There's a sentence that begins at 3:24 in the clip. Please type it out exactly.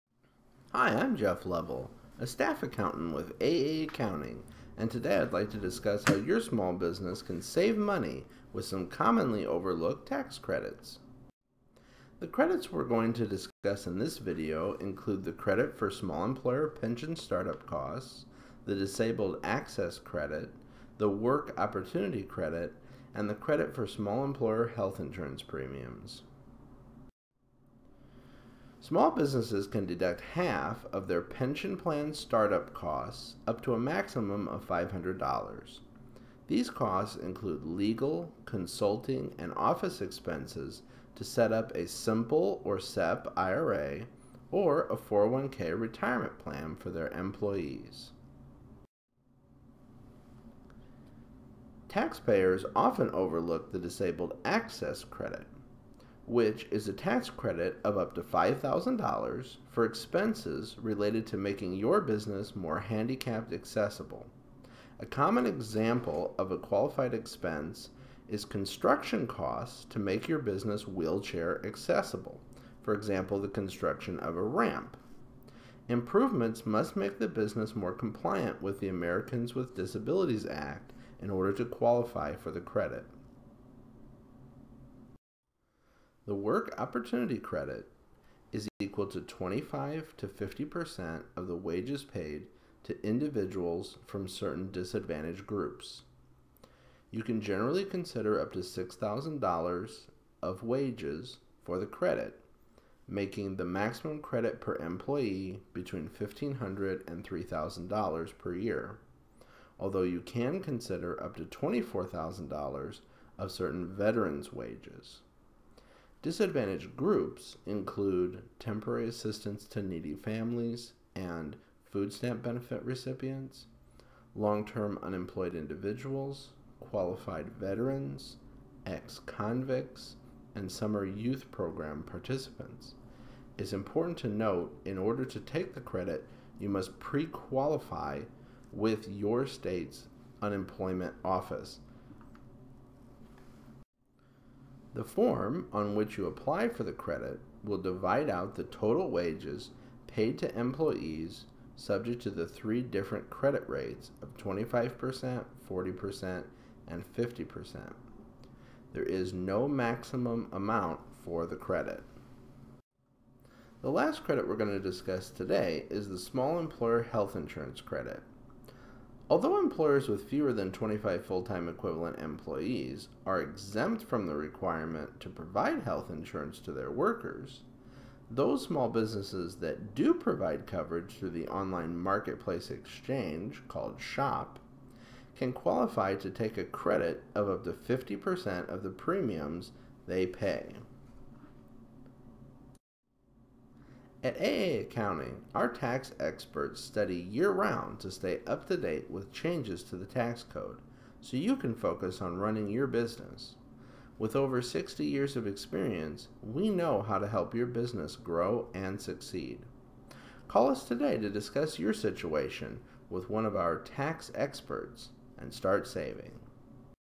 With over 60 years of experience, we know how to help your business grow and succeed.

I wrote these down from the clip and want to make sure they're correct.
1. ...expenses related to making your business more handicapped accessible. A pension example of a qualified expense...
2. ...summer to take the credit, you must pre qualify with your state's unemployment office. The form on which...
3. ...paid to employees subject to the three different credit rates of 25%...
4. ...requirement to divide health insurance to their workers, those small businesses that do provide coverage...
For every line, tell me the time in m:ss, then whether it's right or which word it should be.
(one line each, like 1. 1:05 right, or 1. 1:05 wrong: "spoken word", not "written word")
1. 0:59 wrong: "common", not "pension"
2. 2:14 wrong: "order", not "summer"
3. 2:30 right
4. 2:54 wrong: "provide", not "divide".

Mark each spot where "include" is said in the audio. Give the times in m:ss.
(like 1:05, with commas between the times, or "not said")
0:14, 0:37, 1:57.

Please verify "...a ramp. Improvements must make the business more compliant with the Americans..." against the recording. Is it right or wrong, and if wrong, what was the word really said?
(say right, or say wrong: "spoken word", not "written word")
right.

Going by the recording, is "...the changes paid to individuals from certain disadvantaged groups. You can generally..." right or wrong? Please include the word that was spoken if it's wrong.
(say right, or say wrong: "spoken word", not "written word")
wrong: "wages", not "changes".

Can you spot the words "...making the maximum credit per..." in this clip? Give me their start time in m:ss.
1:43.